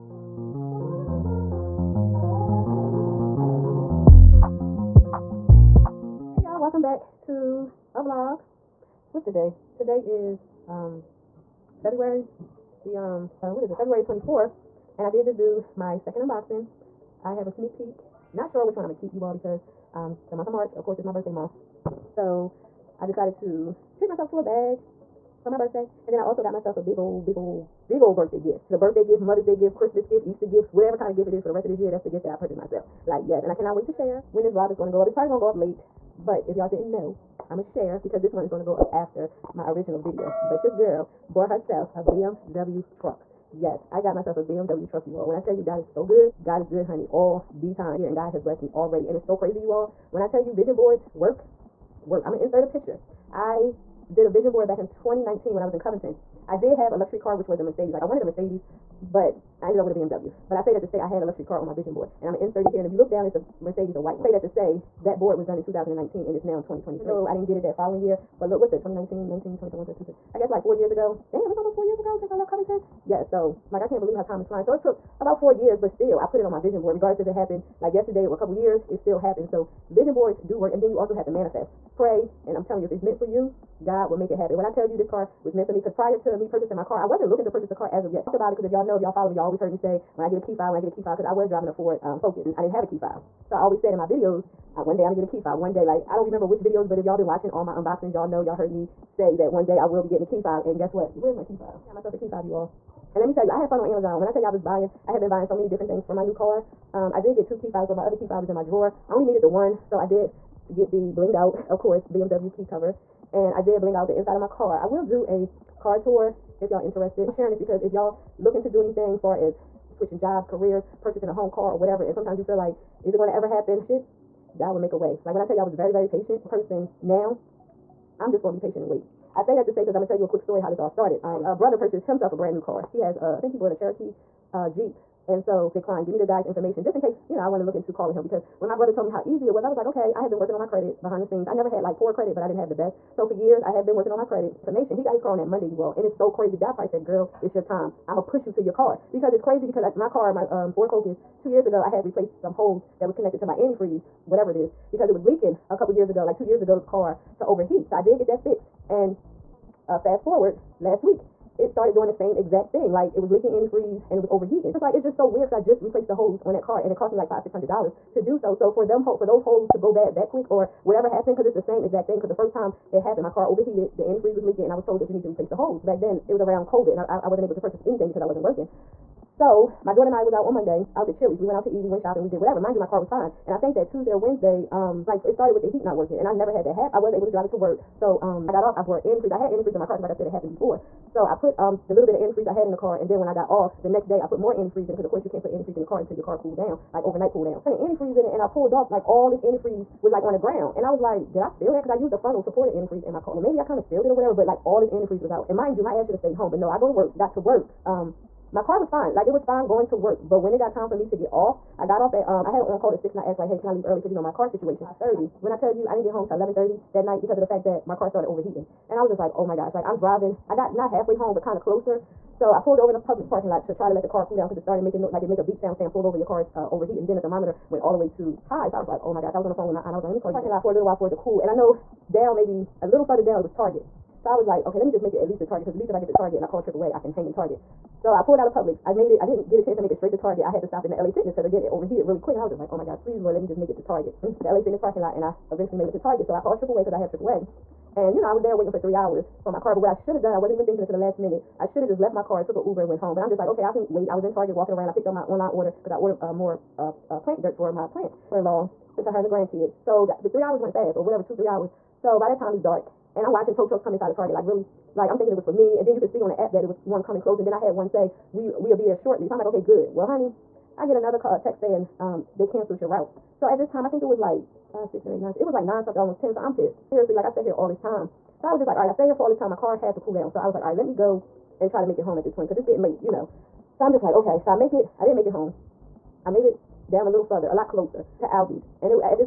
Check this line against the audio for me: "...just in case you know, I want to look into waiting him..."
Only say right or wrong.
wrong.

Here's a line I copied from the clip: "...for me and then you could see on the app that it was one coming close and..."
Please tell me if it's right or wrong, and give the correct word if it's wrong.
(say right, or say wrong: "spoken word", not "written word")
right.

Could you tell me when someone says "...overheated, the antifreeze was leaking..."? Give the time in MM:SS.
02:53.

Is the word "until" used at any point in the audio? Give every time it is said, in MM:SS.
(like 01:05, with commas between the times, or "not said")
03:15, 04:10.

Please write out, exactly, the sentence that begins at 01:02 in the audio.
And I'm going to insert it here.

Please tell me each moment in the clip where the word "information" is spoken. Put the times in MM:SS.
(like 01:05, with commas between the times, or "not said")
02:16, 02:24.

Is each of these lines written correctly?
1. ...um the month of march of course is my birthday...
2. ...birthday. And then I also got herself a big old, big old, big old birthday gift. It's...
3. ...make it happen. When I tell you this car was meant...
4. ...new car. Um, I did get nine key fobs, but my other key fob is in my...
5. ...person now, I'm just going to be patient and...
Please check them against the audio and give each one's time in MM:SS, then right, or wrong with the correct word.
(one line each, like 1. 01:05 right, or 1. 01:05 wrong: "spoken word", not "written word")
1. 00:19 right
2. 00:25 wrong: "myself", not "herself"
3. 01:24 right
4. 01:46 wrong: "two", not "nine"
5. 02:06 right.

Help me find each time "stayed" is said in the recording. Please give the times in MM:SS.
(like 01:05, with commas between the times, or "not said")
03:26, 04:38.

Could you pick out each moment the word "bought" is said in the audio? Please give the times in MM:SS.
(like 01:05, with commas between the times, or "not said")
00:41, 02:13.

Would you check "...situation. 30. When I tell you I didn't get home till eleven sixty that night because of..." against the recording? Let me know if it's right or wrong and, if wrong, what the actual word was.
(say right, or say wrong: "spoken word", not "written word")
wrong: "thirty", not "sixty".